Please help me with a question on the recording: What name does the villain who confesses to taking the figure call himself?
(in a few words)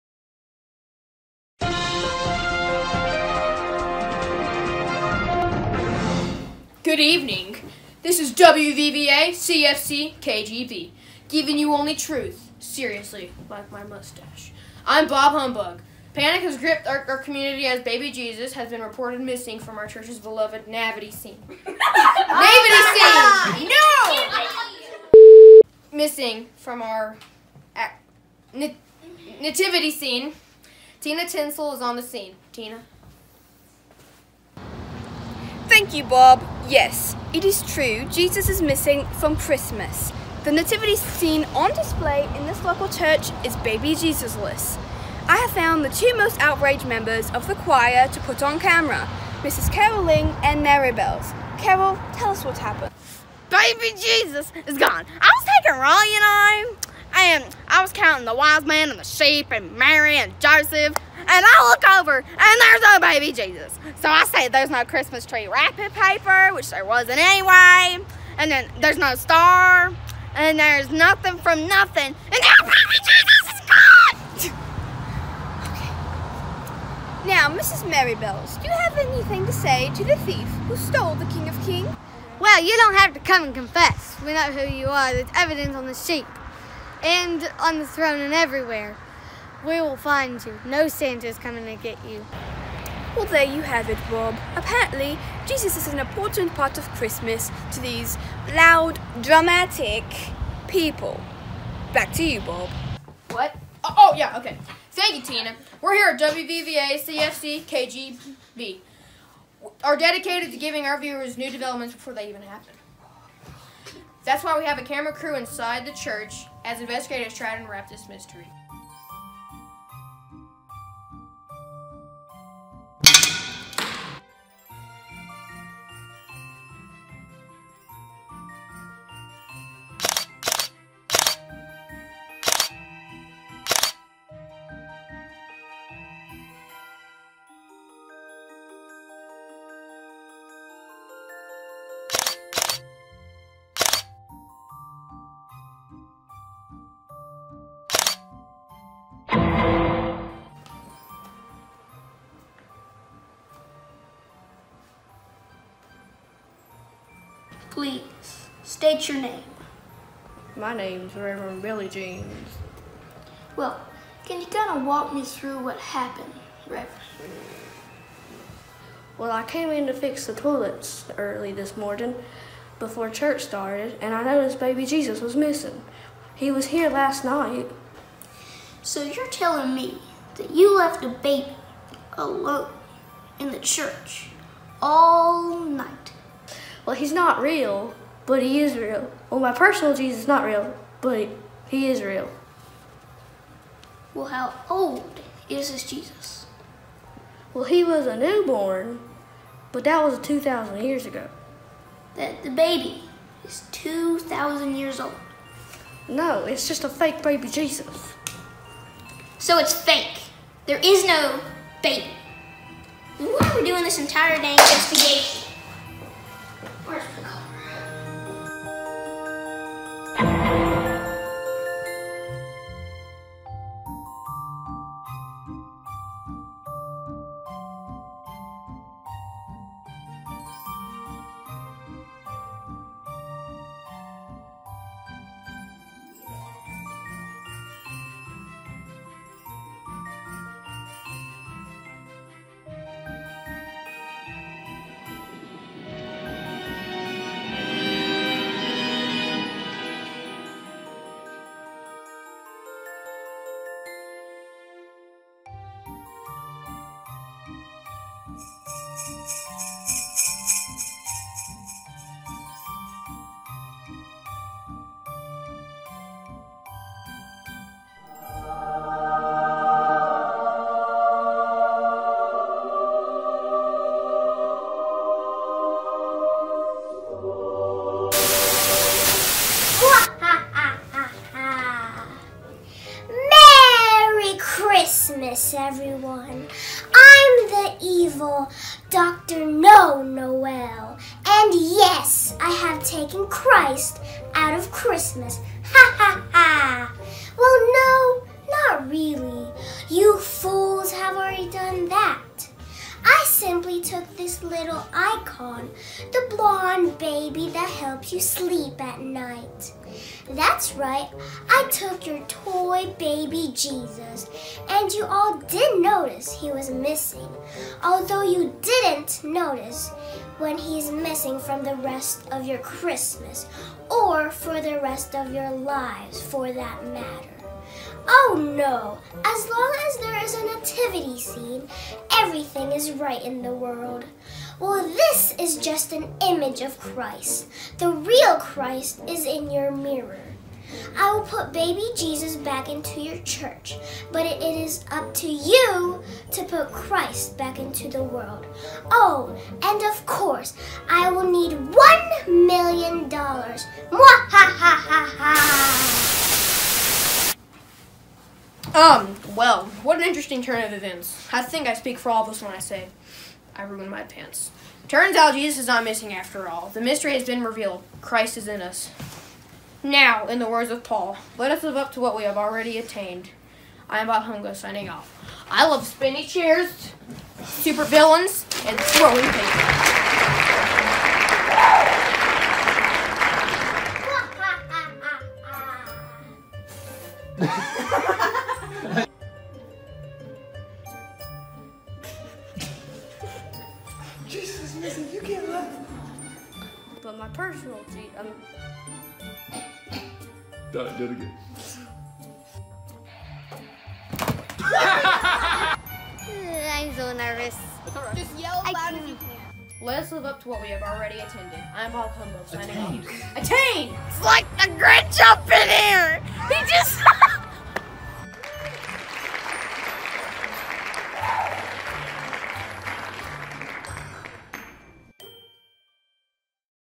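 Dr. No Noel.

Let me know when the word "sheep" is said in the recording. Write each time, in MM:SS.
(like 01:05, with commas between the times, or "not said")
00:59, 01:25.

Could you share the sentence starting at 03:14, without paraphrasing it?
Well, how old is this Jesus?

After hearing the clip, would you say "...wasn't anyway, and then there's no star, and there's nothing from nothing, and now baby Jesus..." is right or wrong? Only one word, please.
right.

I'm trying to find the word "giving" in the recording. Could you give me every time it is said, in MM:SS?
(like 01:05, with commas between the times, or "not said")
00:11, 01:50.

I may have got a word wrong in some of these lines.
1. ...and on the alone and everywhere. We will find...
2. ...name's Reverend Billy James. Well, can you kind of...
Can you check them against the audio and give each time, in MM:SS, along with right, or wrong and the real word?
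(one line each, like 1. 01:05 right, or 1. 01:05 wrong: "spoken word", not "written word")
1. 01:27 wrong: "throne", not "alone"
2. 02:40 right.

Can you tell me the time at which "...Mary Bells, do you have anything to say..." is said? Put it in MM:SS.
01:17.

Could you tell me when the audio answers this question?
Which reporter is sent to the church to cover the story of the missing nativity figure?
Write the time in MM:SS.
00:30.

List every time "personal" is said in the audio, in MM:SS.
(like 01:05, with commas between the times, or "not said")
03:09.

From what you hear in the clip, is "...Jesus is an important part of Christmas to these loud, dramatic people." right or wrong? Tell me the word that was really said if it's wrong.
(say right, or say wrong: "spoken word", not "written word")
right.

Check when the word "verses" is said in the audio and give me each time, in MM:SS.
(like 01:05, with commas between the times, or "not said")
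not said.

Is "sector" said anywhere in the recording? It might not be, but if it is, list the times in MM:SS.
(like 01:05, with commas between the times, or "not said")
not said.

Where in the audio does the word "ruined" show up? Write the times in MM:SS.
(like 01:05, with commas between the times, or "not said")
06:03.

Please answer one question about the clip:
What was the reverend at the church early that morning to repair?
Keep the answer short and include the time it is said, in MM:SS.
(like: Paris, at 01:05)
The toilets, at 02:49.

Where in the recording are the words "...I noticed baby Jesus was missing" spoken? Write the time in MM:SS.
02:54.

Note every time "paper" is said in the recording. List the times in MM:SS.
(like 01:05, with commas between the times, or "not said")
01:05, 06:19.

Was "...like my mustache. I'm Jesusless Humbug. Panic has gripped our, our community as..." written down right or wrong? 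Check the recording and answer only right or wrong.
wrong.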